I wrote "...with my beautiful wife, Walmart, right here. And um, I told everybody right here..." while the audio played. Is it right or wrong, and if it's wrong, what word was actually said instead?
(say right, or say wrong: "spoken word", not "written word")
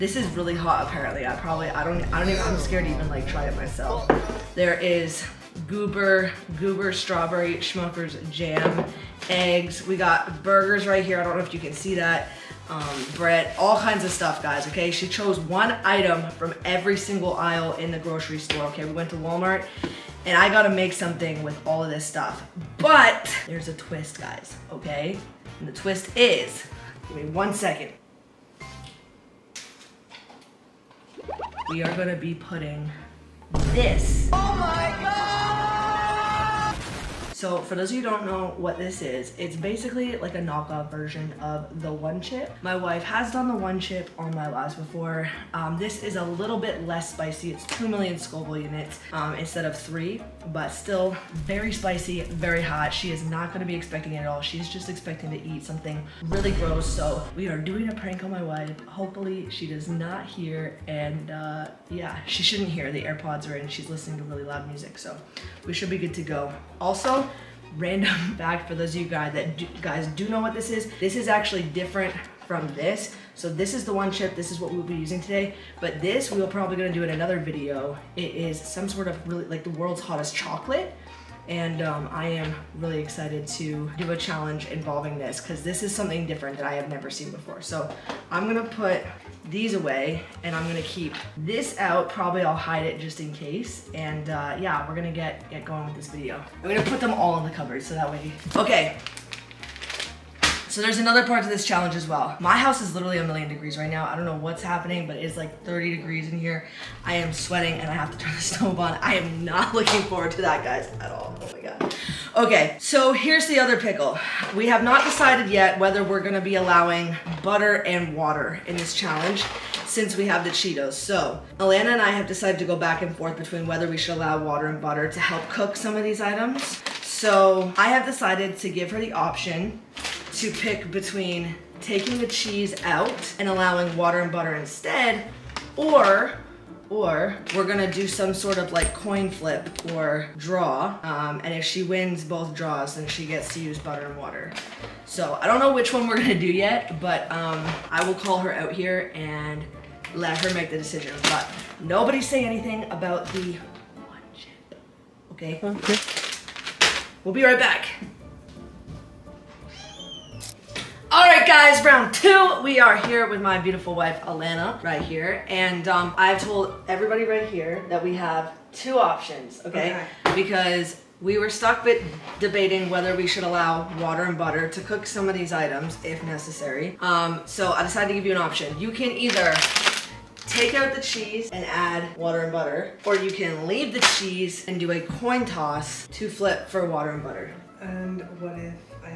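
wrong: "Alana", not "Walmart".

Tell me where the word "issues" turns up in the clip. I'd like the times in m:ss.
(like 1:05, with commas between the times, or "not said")
not said.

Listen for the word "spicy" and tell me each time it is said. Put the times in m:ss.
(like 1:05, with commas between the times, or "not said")
0:47, 0:51.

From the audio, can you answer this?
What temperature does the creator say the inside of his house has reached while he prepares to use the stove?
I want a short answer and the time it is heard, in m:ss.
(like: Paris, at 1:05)
30 degrees, at 1:45.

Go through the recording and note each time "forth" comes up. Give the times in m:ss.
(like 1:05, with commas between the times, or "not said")
2:03.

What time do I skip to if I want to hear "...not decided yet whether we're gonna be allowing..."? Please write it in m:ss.
1:54.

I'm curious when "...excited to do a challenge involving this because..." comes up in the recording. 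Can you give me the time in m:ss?
1:22.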